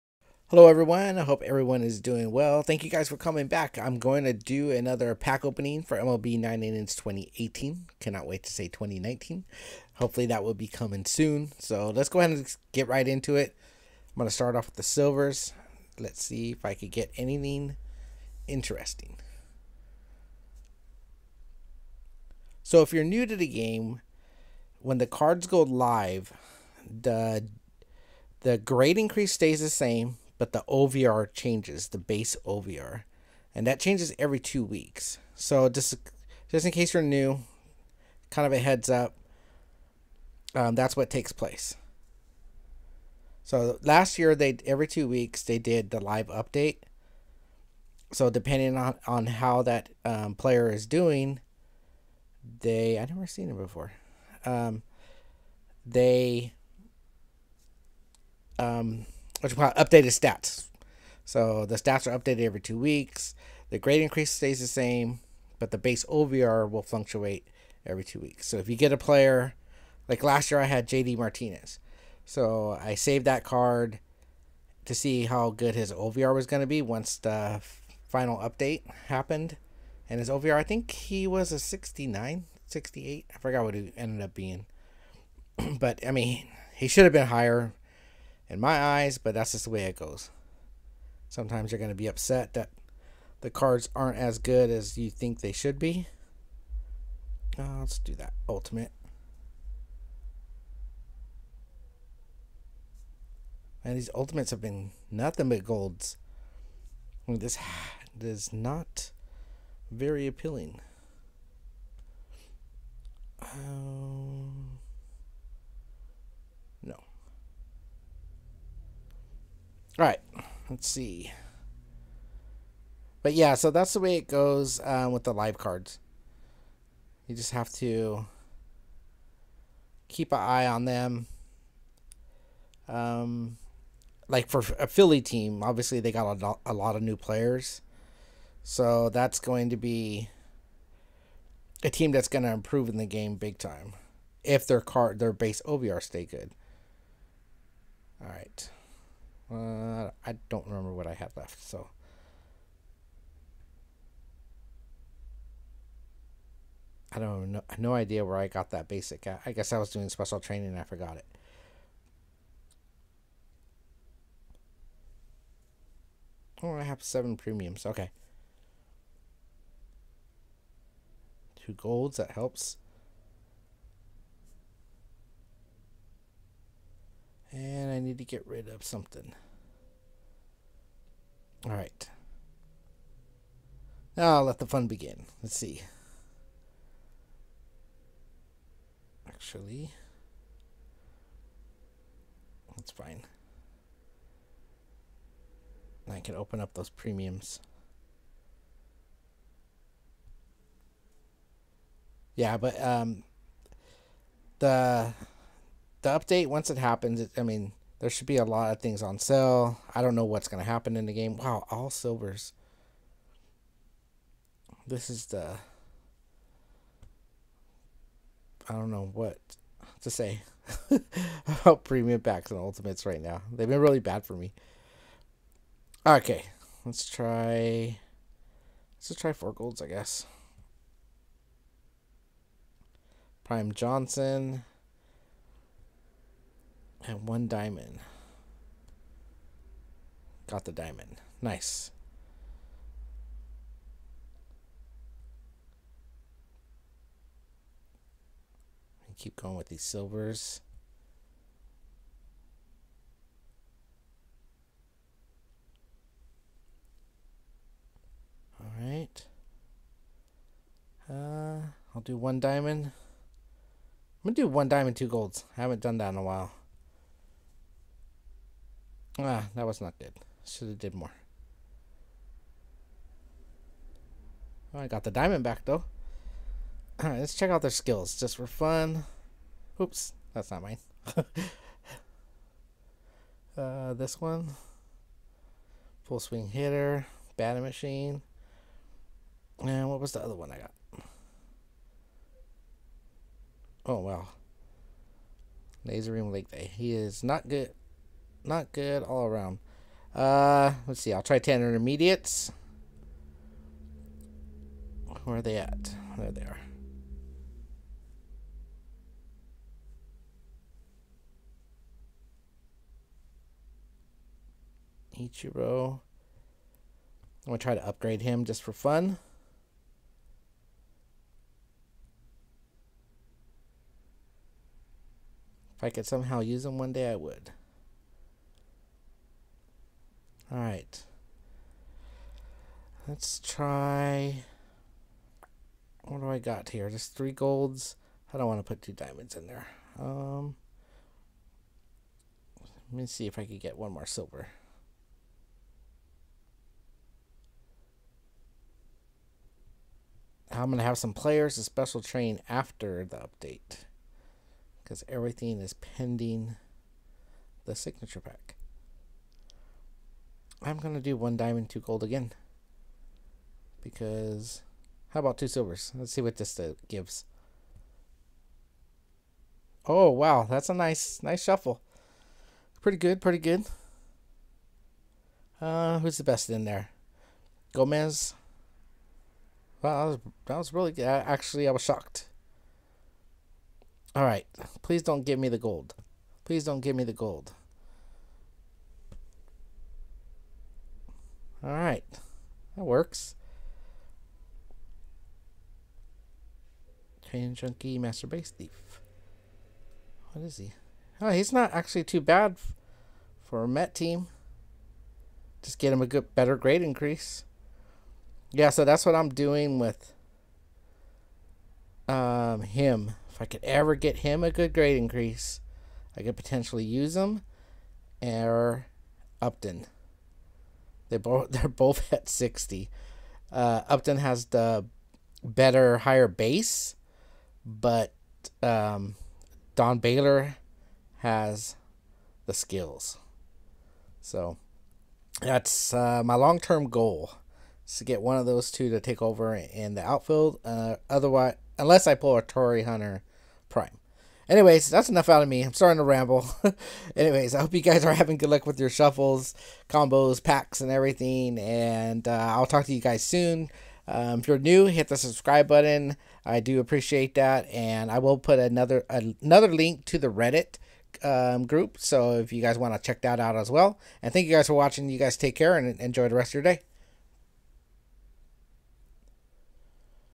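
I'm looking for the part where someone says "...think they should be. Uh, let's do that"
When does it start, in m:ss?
1:35.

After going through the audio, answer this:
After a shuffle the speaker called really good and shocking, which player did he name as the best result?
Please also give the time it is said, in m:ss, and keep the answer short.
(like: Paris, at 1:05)
Gomez, at 6:17.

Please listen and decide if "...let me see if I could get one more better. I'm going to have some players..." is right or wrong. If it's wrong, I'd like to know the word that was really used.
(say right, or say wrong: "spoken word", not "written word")
wrong: "silver", not "better".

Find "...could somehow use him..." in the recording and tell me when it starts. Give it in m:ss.
5:25.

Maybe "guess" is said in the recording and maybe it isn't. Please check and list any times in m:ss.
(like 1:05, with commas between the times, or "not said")
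2:39, 3:49.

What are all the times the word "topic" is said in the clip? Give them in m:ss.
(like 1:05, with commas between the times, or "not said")
not said.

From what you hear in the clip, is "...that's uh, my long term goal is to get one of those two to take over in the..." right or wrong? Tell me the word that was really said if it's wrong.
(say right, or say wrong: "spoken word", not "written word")
right.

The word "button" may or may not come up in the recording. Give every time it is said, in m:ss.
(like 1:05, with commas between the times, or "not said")
7:35.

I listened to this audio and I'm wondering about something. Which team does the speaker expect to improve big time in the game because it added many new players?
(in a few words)
Philly.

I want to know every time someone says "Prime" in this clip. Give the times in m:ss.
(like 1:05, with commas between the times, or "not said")
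3:53, 7:23.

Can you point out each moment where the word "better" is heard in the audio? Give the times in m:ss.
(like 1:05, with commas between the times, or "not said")
6:46, 7:05.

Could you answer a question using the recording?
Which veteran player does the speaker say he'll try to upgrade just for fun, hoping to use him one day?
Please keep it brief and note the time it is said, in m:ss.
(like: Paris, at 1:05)
Ichiro, at 5:15.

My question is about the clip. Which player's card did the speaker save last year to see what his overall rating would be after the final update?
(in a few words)
JD Martinez.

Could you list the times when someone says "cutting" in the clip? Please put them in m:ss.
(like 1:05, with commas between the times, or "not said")
not said.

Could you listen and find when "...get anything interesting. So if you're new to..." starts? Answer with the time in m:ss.
0:16.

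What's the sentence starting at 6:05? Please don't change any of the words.
Let's see what this uh, gives.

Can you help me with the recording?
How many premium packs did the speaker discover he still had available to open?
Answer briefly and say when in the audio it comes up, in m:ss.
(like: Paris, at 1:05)
7, at 2:47.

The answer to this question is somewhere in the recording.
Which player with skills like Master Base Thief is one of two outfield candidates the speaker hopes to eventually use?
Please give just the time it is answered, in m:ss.
7:09.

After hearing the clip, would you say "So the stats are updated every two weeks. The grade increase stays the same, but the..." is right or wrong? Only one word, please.
right.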